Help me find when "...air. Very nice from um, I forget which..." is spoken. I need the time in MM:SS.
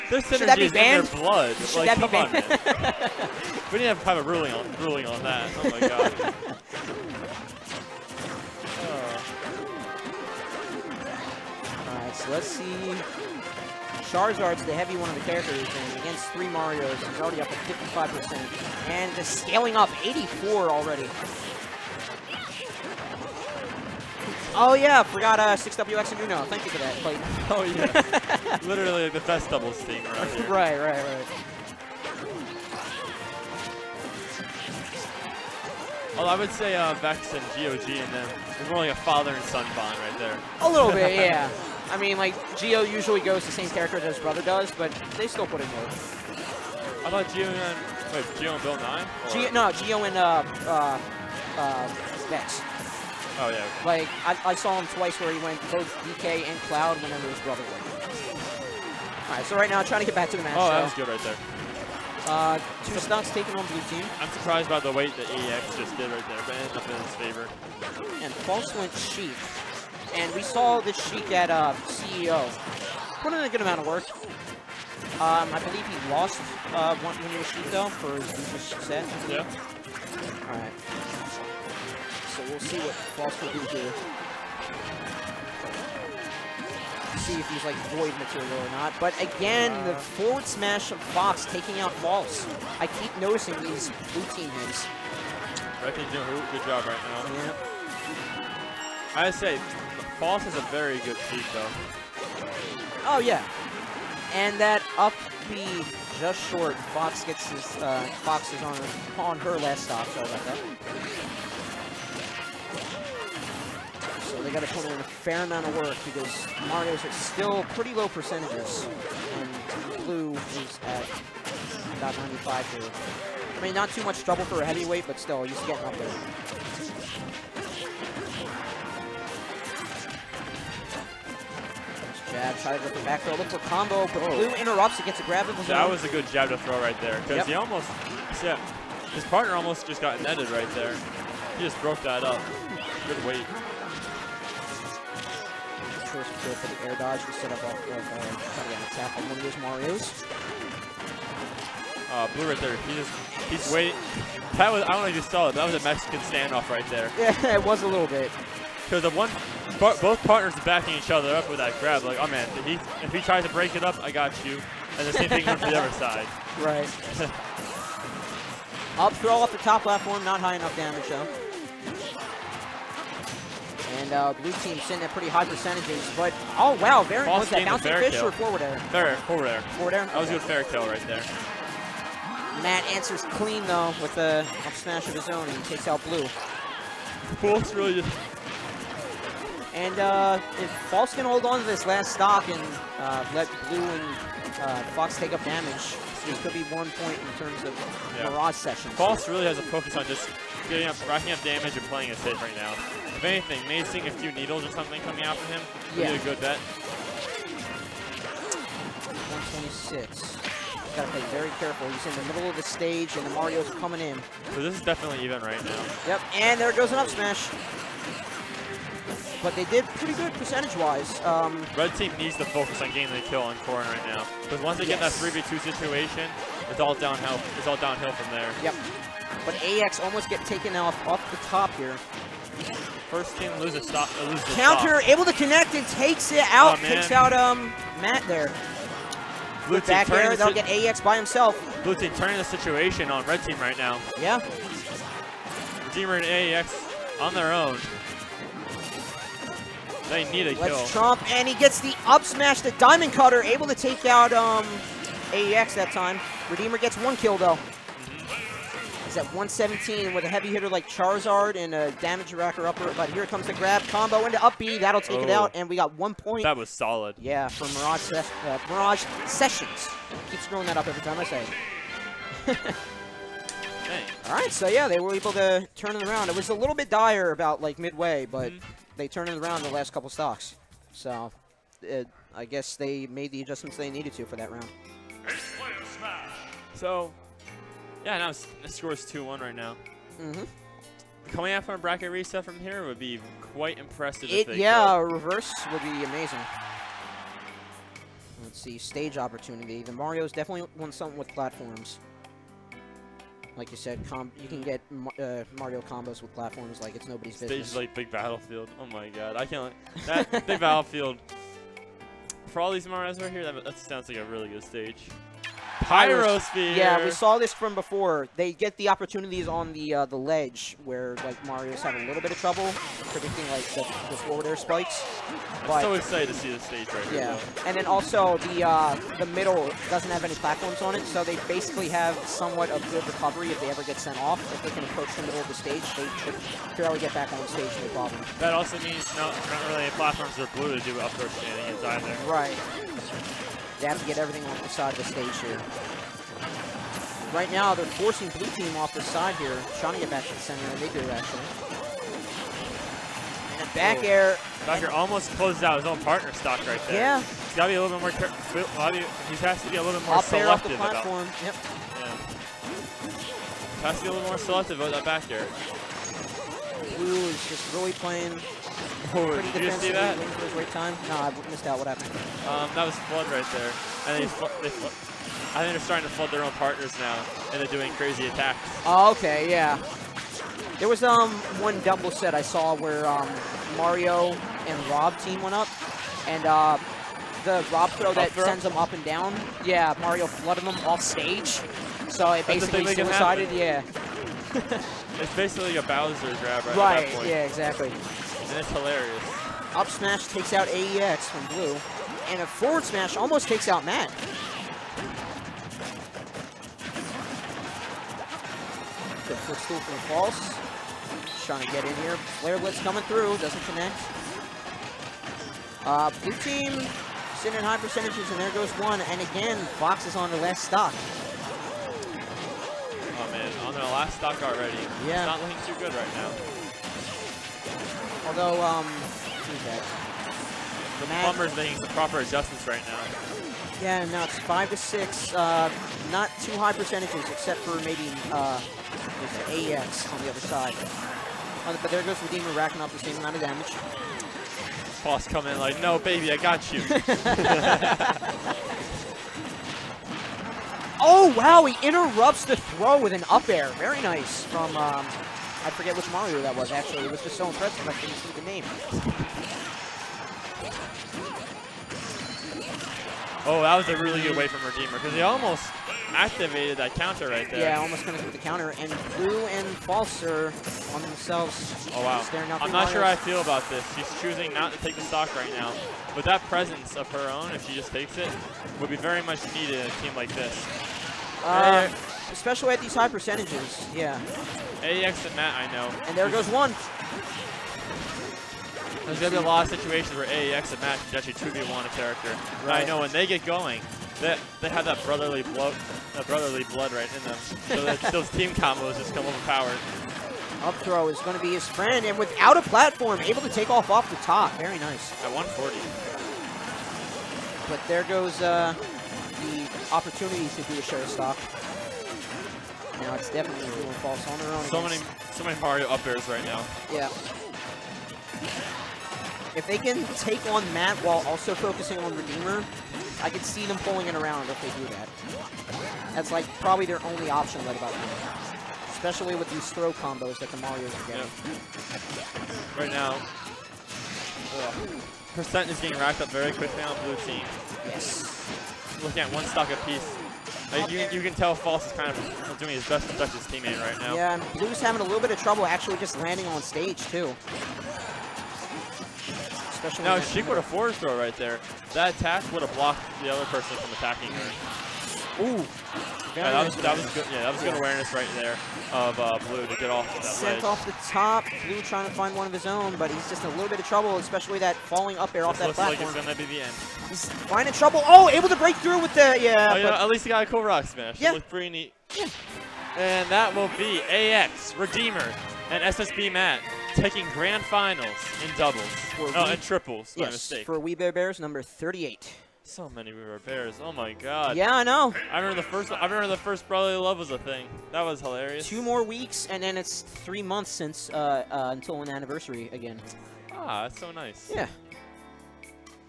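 07:33.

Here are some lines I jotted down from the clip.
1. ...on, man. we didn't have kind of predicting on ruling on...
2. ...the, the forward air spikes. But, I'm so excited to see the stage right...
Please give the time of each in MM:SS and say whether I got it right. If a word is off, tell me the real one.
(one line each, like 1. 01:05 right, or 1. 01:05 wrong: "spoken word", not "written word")
1. 00:02 wrong: "ruling", not "predicting"
2. 05:23 right.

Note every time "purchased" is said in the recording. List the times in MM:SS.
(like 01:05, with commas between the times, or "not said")
not said.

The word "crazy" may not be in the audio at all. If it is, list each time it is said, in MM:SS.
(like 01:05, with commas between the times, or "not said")
06:17.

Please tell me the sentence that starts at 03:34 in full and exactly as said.
So this is definitely even right now.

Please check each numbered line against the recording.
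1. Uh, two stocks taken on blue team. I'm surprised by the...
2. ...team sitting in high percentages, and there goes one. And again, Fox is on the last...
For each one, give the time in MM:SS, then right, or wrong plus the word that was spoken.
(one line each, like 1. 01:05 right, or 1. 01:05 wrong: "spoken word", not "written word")
1. 01:02 right
2. 06:56 right.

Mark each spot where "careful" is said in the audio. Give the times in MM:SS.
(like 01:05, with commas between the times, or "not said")
03:31, 05:58.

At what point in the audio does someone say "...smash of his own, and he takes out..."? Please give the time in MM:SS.
03:04.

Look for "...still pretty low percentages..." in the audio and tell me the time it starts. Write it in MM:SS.
01:57.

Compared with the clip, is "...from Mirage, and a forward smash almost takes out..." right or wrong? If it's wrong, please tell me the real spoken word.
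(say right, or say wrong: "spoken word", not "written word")
wrong: "Blue", not "Mirage".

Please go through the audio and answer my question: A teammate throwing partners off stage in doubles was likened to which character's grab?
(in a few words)
Bowser.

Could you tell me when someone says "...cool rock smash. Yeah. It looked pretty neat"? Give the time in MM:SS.
09:30.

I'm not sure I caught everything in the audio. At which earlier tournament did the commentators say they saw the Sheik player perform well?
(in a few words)
CEO.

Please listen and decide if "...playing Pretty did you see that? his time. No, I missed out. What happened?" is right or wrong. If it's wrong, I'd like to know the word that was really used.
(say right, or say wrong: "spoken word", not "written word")
right.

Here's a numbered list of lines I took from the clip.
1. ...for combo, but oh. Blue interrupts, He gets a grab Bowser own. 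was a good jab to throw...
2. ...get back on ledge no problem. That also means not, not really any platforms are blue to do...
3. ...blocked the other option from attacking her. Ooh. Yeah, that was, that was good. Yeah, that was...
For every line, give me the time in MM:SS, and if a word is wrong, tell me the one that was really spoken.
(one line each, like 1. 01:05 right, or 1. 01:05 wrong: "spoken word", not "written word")
1. 02:13 wrong: "That", not "Bowser"
2. 05:36 wrong: "stage", not "ledge"
3. 09:12 wrong: "person", not "option".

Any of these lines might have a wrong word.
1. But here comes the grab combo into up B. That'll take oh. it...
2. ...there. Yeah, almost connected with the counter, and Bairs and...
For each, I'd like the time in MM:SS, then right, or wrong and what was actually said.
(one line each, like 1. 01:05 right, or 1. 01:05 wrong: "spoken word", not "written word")
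1. 04:22 right
2. 07:47 wrong: "Blue", not "Bairs".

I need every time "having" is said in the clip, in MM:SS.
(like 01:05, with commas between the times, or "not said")
05:21, 09:04.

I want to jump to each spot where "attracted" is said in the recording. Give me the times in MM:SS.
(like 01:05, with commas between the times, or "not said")
not said.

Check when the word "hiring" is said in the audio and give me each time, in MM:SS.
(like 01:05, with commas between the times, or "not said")
not said.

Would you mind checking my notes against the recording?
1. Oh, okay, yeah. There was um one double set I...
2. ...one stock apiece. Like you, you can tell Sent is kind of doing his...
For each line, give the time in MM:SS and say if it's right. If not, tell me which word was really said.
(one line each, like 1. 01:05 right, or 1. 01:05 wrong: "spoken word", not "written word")
1. 06:18 right
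2. 08:59 wrong: "False", not "Sent".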